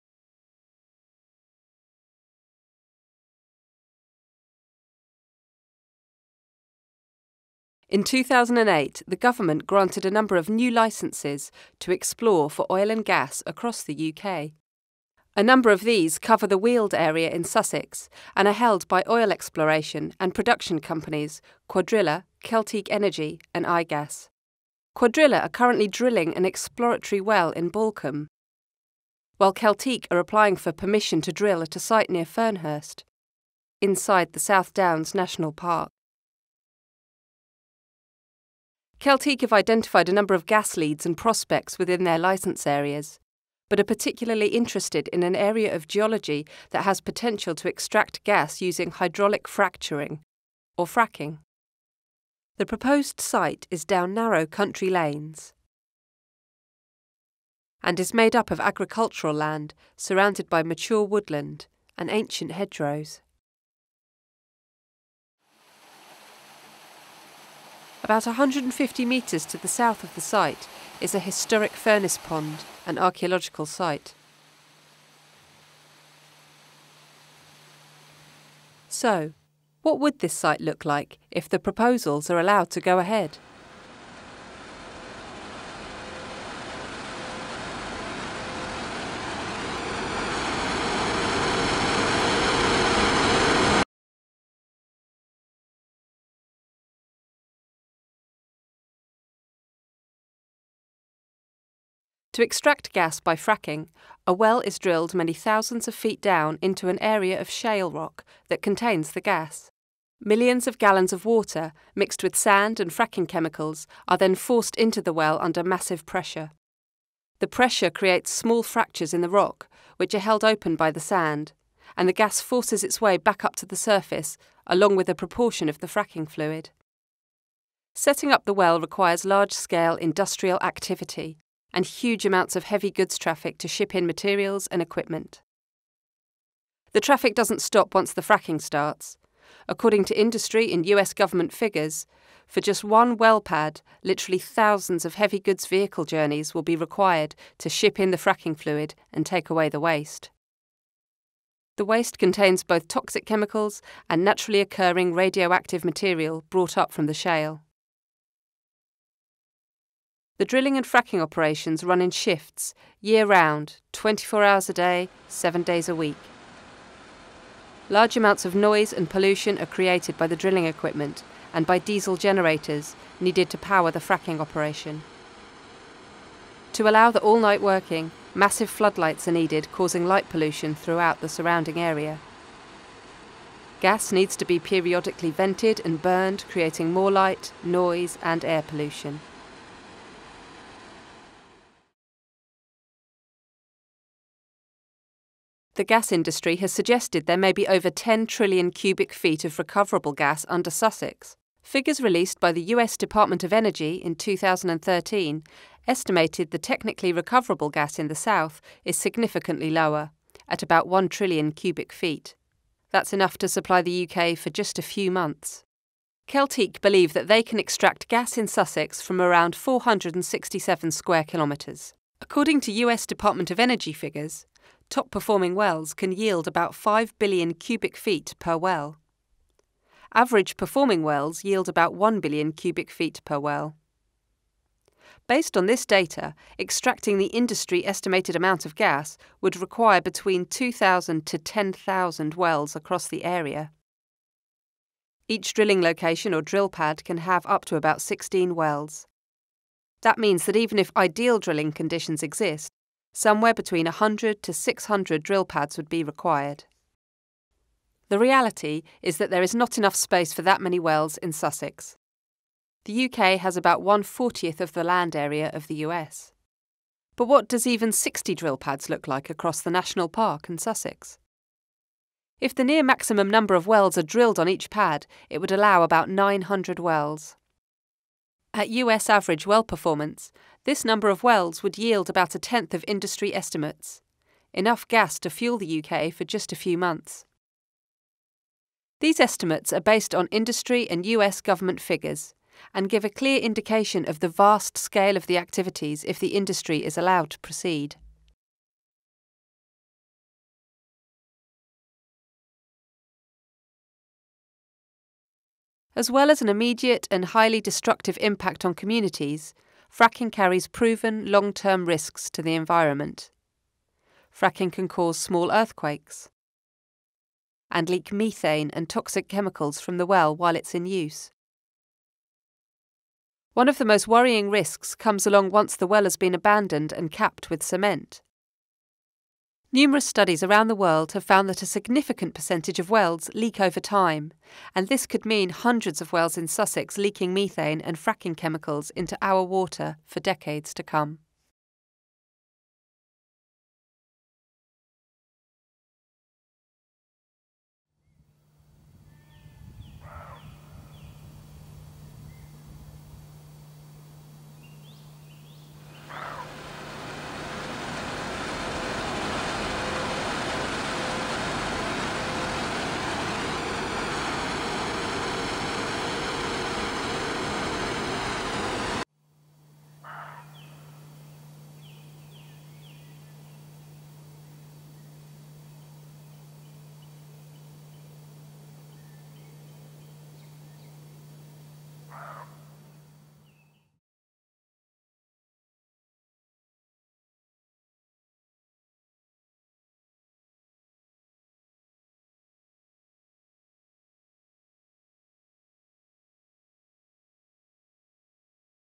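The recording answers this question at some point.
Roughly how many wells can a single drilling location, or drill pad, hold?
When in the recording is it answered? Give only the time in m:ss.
4:08.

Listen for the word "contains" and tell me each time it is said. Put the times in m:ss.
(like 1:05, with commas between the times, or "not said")
1:48, 2:32.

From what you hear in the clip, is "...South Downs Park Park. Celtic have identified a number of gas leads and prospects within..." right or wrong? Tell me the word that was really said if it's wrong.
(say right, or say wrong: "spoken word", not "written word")
wrong: "National", not "Park".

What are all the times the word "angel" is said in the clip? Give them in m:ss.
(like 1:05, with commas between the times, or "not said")
not said.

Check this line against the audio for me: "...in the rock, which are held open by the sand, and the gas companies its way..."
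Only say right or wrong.
wrong.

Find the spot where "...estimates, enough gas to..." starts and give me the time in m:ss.
4:43.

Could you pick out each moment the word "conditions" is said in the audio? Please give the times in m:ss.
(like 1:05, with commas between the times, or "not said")
4:11.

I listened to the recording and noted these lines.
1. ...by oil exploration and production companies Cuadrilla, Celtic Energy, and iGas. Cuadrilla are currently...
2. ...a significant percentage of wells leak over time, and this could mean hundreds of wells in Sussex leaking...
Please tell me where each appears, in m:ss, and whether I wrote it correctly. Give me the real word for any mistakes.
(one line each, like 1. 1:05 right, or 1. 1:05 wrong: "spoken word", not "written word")
1. 0:18 right
2. 5:31 right.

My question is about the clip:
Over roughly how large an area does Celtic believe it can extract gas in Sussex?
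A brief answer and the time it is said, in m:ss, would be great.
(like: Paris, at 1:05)
467 square kilometres, at 3:39.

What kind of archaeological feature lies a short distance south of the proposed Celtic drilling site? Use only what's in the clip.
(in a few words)
historic furnace pond.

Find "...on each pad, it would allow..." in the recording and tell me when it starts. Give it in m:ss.
4:34.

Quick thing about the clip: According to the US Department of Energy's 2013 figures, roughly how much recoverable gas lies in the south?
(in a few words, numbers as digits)
1 trillion cubic feet.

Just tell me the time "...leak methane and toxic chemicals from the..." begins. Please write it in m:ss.
5:17.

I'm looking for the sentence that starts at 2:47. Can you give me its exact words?
Large amounts of noise and pollution are created by the drilling equipment and by diesel generators needed to power the fracking operation.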